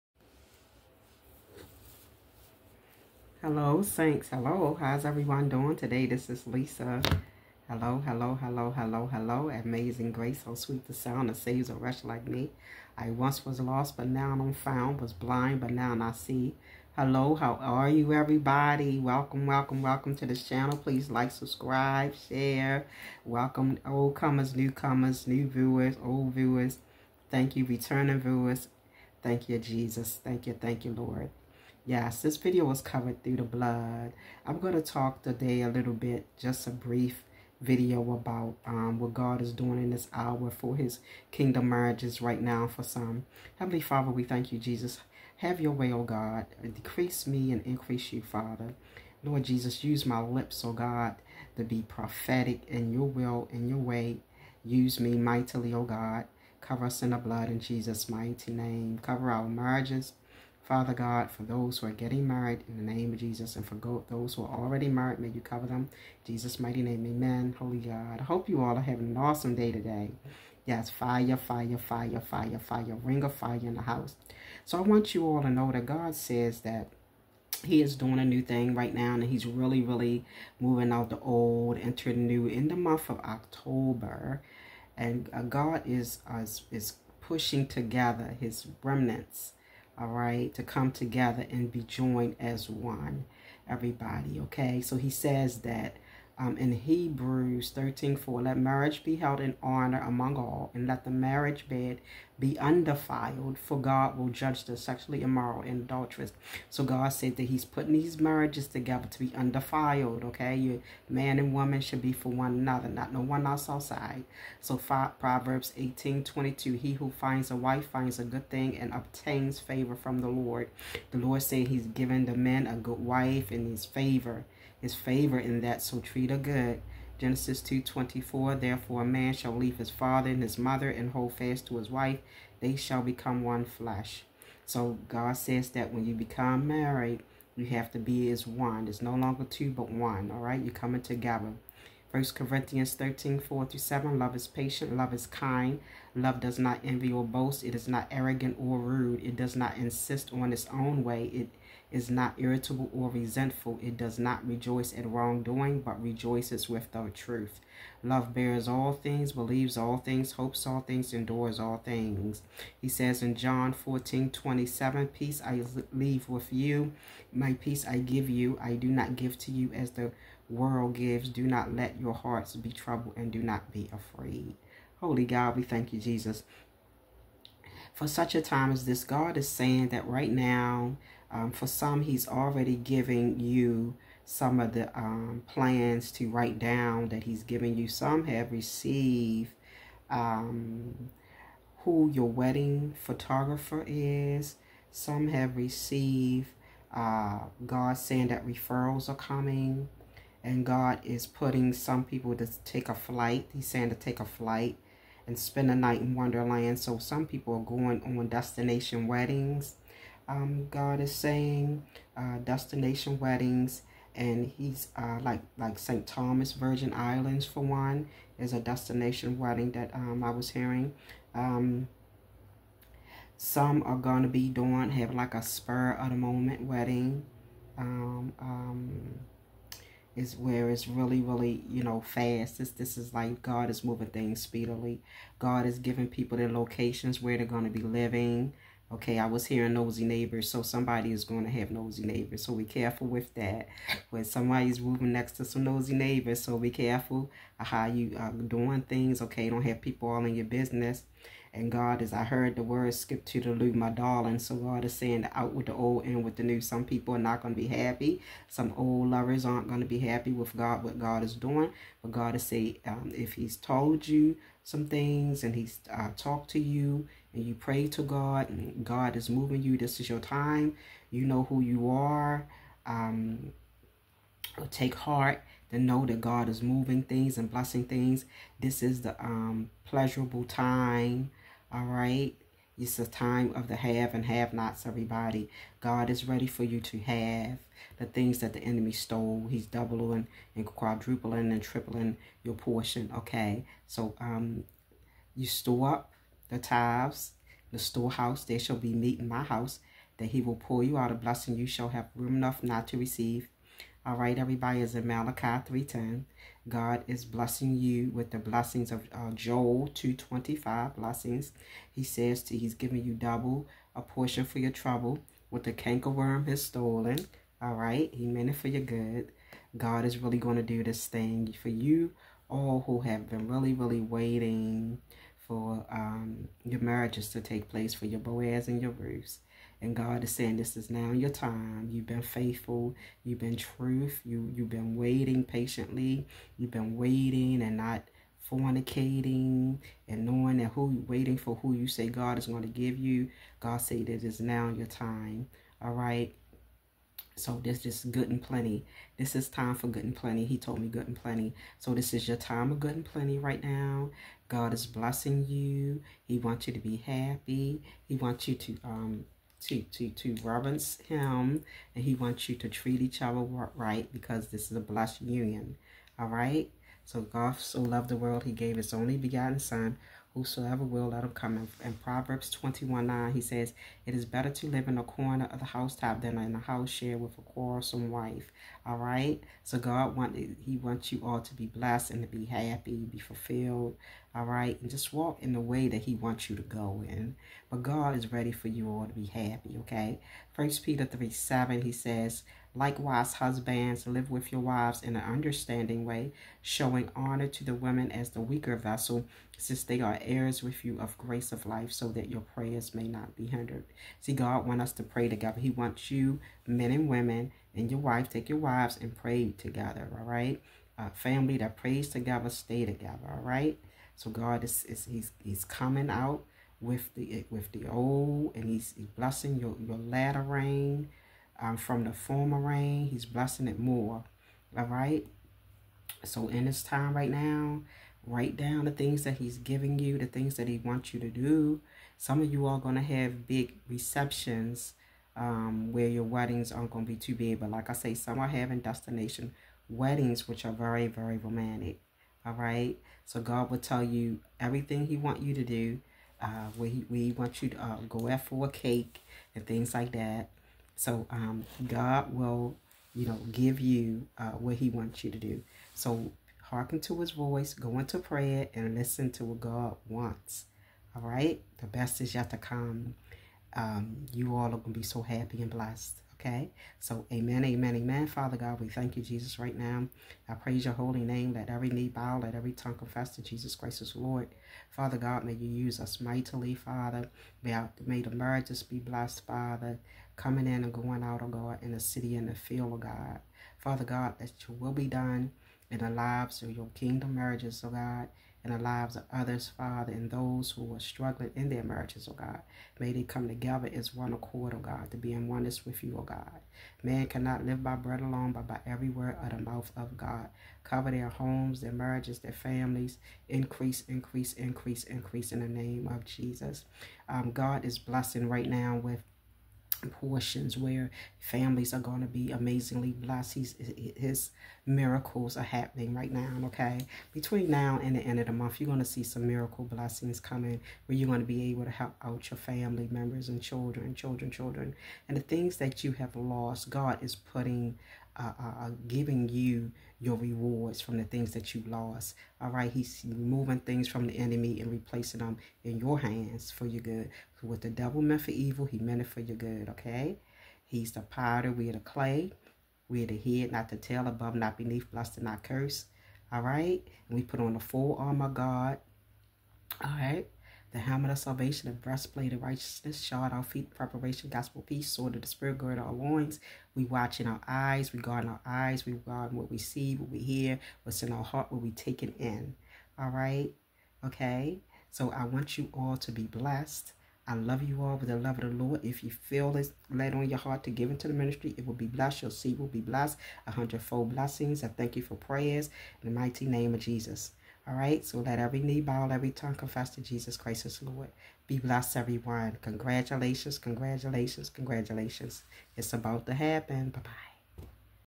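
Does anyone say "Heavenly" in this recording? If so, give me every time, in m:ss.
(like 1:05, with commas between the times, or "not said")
0:43.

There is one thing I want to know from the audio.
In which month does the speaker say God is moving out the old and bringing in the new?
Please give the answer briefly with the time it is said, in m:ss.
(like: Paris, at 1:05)
October, at 1:23.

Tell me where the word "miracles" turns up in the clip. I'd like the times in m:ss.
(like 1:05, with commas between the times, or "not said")
8:34, 8:39.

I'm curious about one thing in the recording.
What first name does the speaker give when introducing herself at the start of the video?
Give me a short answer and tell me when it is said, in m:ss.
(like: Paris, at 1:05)
Lisa, at 0:06.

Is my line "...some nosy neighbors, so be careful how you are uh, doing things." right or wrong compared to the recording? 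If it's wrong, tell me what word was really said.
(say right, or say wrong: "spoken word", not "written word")
right.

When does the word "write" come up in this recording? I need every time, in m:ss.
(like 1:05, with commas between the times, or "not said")
3:06, 7:08.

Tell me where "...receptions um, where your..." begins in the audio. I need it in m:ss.
7:13.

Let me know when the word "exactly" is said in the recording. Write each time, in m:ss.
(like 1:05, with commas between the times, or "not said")
not said.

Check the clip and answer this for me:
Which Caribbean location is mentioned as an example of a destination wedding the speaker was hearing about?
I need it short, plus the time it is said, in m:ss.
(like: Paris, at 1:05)
St. Thomas Virgin Islands, at 3:35.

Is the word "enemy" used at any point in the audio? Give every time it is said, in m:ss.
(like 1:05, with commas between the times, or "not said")
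4:48, 8:54.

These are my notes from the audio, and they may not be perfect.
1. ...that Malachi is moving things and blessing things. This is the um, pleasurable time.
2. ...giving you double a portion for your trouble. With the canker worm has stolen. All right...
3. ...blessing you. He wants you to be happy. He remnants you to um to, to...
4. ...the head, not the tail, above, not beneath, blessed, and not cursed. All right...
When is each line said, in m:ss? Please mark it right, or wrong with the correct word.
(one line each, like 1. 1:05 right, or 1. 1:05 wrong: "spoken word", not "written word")
1. 4:36 wrong: "God", not "Malachi"
2. 5:12 right
3. 5:54 wrong: "wants", not "remnants"
4. 9:03 right.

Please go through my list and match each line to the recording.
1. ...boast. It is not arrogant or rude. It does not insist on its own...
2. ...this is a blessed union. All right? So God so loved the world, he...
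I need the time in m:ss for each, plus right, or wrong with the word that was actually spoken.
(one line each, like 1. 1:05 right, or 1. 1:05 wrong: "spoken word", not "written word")
1. 2:27 right
2. 6:04 right.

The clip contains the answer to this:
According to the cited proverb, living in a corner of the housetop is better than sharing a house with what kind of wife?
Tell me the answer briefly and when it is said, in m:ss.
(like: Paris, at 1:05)
Quarrelsome, at 6:17.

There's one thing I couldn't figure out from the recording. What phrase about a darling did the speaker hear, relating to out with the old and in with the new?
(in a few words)
Skip to the loo.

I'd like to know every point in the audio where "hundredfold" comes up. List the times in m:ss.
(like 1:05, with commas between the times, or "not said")
9:33.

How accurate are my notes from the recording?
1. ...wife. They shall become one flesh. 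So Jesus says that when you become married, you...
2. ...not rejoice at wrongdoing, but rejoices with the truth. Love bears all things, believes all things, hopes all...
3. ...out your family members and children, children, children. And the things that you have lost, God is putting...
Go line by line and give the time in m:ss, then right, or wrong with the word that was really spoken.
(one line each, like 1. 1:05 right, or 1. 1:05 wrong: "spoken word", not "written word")
1. 2:11 wrong: "God", not "Jesus"
2. 2:34 right
3. 8:42 right.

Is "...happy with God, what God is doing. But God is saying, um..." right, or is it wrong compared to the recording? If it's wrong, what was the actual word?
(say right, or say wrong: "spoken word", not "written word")
right.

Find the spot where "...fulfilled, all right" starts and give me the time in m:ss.
6:23.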